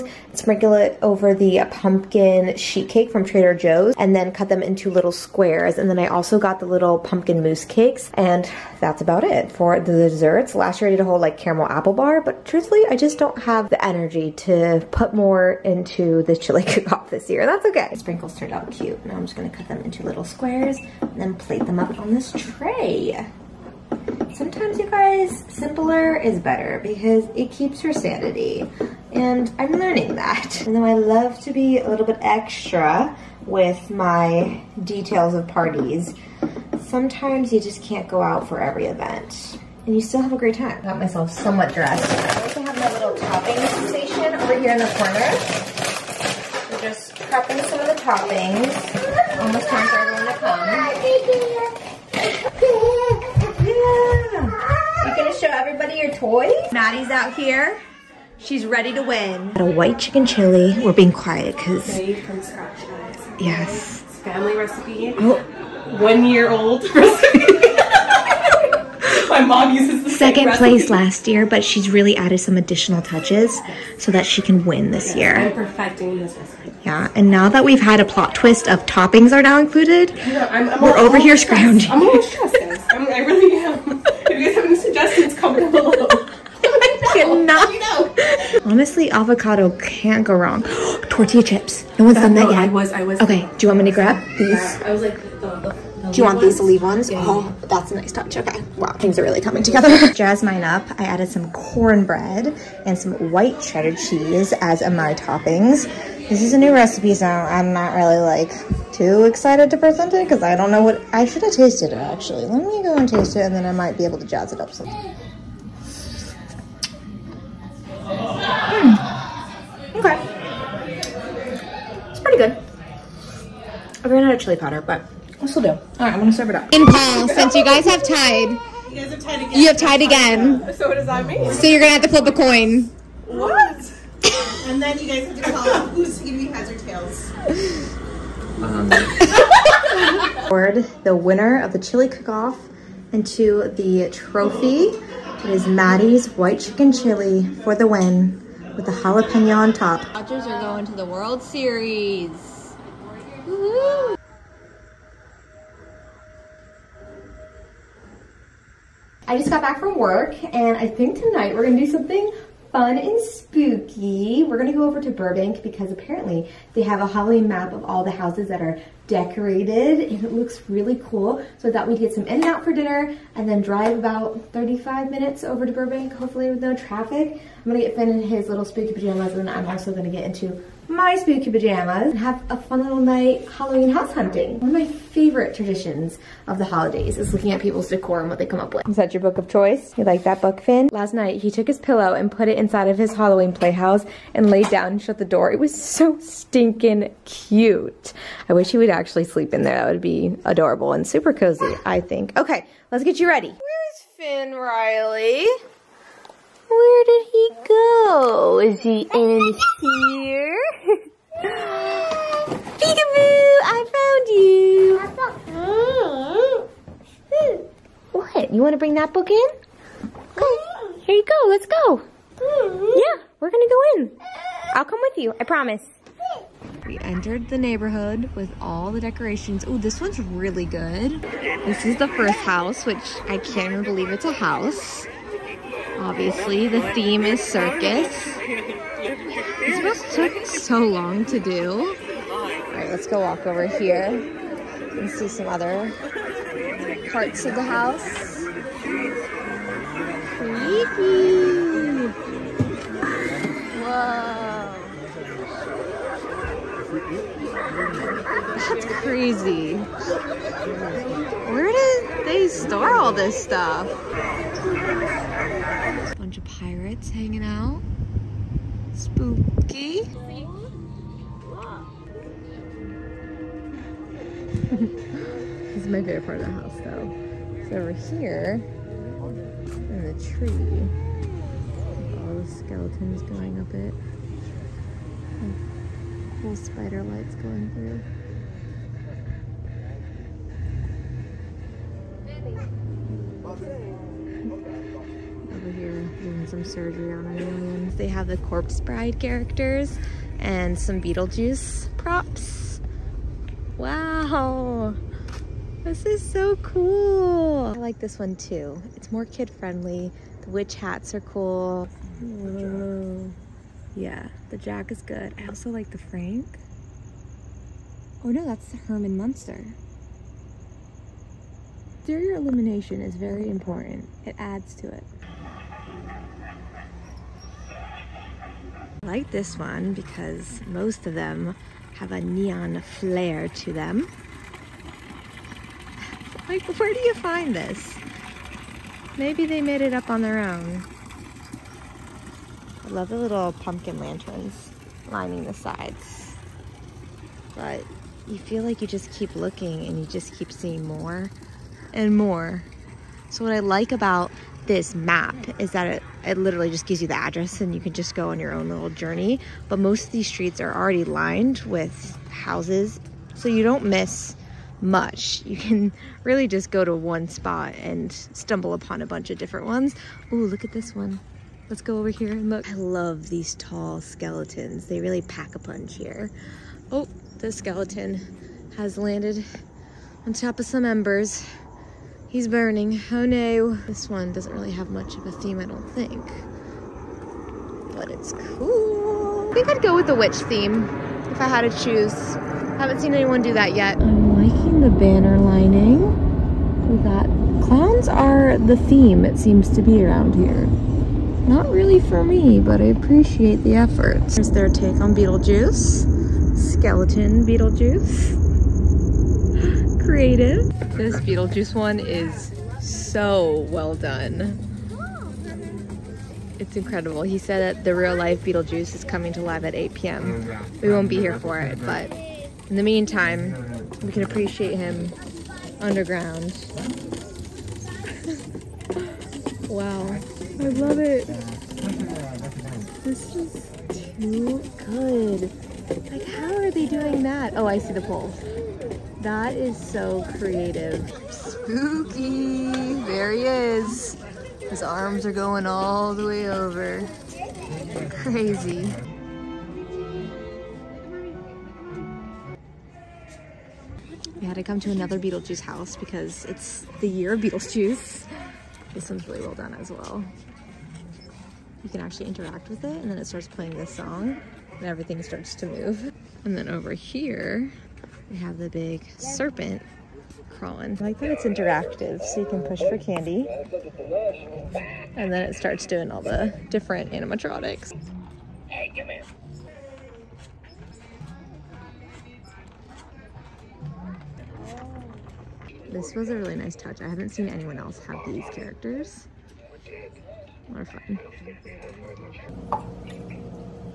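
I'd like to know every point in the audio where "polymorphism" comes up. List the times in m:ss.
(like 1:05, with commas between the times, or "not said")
not said.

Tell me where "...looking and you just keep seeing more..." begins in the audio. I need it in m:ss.
5:49.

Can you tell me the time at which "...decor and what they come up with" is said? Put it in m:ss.
3:07.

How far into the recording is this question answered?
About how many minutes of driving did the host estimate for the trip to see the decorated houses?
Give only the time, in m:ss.
2:54.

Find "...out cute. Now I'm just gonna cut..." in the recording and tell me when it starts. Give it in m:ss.
0:18.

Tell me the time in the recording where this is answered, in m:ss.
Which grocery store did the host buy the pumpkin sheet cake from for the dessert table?
0:03.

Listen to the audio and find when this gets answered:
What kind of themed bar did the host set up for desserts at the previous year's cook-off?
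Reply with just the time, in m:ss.
0:11.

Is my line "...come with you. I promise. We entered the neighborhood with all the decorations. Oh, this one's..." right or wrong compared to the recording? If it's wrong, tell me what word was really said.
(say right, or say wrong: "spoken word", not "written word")
right.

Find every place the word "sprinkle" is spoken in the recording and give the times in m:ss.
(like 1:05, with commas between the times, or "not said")
0:00, 0:17.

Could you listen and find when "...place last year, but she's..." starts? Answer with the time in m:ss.
1:10.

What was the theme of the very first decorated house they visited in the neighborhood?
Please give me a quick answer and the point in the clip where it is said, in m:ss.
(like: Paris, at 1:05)
circus, at 3:57.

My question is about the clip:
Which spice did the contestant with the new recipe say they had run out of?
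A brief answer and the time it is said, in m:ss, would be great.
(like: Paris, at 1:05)
chili powder, at 2:04.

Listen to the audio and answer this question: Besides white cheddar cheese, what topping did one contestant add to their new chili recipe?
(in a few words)
cornbread.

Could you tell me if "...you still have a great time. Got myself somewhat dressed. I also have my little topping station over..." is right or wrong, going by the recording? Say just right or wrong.
right.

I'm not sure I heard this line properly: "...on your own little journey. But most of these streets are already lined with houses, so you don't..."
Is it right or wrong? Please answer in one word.
right.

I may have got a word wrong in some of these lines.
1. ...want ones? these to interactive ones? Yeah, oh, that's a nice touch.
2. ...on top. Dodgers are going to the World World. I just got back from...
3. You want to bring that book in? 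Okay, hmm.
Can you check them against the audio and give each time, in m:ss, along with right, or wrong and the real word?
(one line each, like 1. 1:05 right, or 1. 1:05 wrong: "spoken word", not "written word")
1. 1:36 wrong: "leave", not "interactive"
2. 2:29 wrong: "Series", not "World"
3. 3:38 right.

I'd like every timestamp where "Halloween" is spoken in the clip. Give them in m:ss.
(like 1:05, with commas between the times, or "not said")
2:47, 3:03, 3:13.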